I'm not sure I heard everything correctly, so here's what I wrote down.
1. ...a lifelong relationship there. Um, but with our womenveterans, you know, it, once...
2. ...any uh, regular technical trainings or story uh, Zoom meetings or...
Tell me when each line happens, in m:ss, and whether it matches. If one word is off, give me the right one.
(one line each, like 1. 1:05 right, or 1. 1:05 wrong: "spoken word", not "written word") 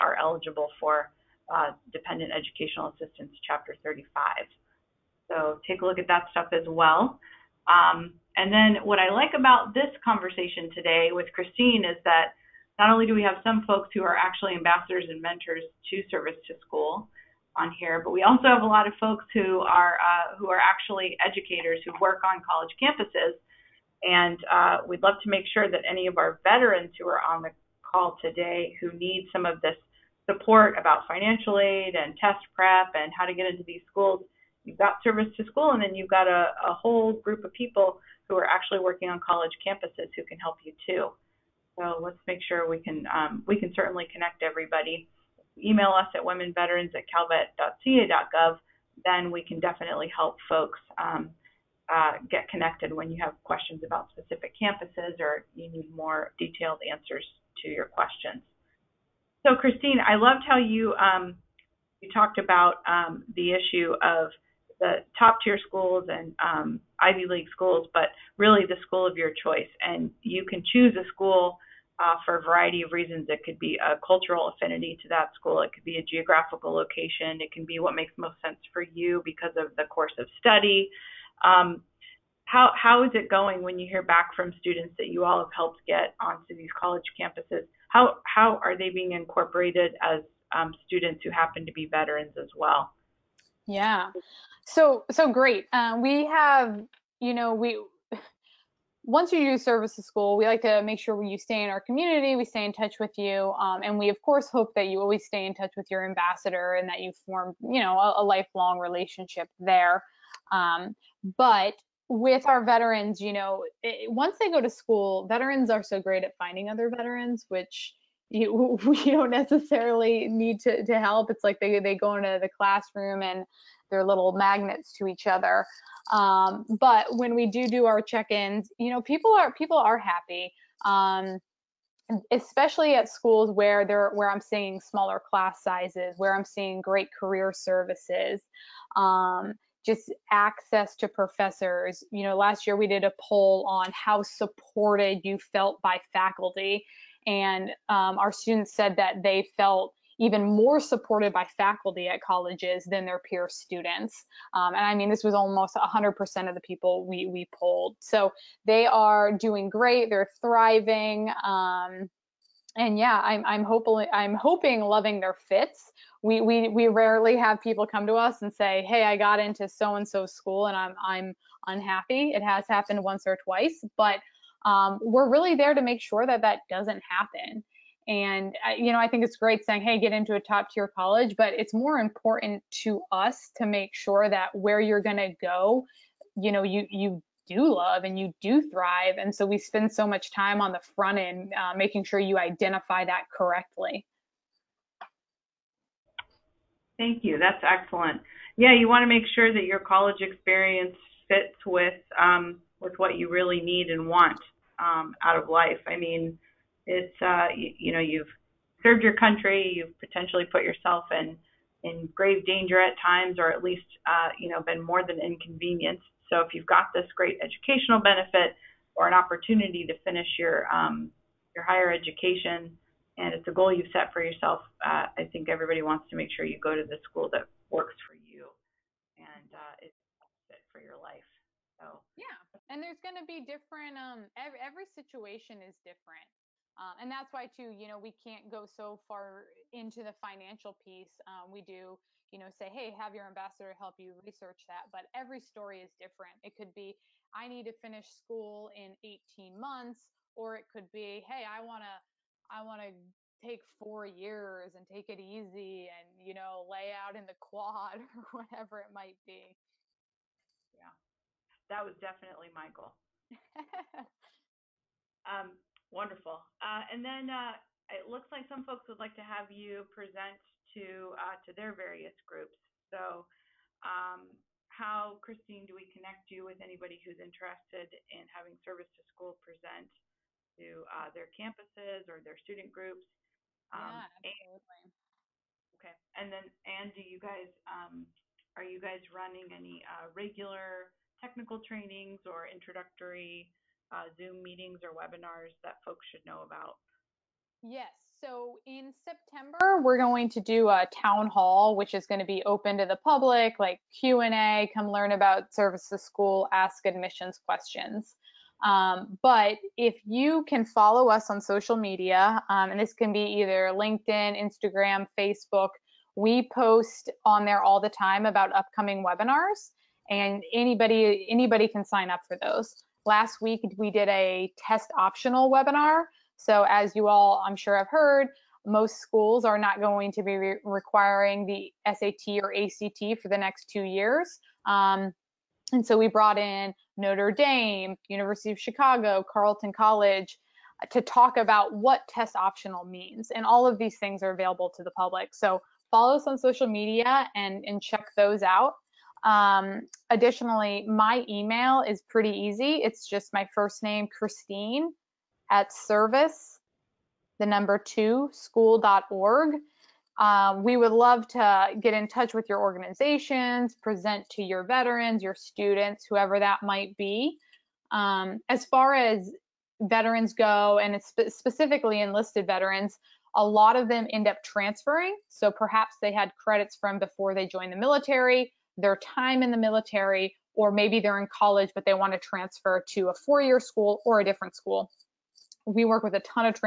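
1. 1:48 wrong: "veterans", not "womenveterans"
2. 4:49 wrong: "introductory", not "story".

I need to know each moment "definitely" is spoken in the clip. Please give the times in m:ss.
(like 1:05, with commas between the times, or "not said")
0:49, 4:22.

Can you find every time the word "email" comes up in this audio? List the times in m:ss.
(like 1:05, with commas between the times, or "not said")
0:45, 5:51.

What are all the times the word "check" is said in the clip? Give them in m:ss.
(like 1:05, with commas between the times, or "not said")
2:08, 5:47.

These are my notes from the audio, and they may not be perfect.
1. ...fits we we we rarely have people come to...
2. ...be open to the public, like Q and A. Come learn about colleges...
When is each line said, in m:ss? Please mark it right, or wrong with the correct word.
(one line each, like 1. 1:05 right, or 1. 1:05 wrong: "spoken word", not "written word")
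1. 2:45 right
2. 5:02 wrong: "services", not "colleges".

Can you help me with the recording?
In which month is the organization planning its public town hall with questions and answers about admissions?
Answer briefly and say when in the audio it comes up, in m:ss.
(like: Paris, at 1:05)
September, at 4:58.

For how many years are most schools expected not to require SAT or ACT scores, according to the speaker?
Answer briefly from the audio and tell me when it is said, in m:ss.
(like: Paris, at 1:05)
2 years, at 5:33.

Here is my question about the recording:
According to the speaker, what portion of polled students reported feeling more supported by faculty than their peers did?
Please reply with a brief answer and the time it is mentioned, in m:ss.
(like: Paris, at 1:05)
almost 100%, at 2:35.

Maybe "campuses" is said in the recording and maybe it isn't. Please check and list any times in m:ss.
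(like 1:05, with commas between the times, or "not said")
0:22, 0:39, 0:54, 1:27, 4:41.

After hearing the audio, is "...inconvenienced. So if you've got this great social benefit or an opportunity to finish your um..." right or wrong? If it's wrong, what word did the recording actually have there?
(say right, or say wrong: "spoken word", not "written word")
wrong: "educational", not "social".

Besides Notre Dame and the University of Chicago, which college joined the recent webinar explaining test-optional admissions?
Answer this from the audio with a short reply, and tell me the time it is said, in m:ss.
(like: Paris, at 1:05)
Carleton College, at 5:39.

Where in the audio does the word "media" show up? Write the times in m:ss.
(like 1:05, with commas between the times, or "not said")
5:11, 5:46.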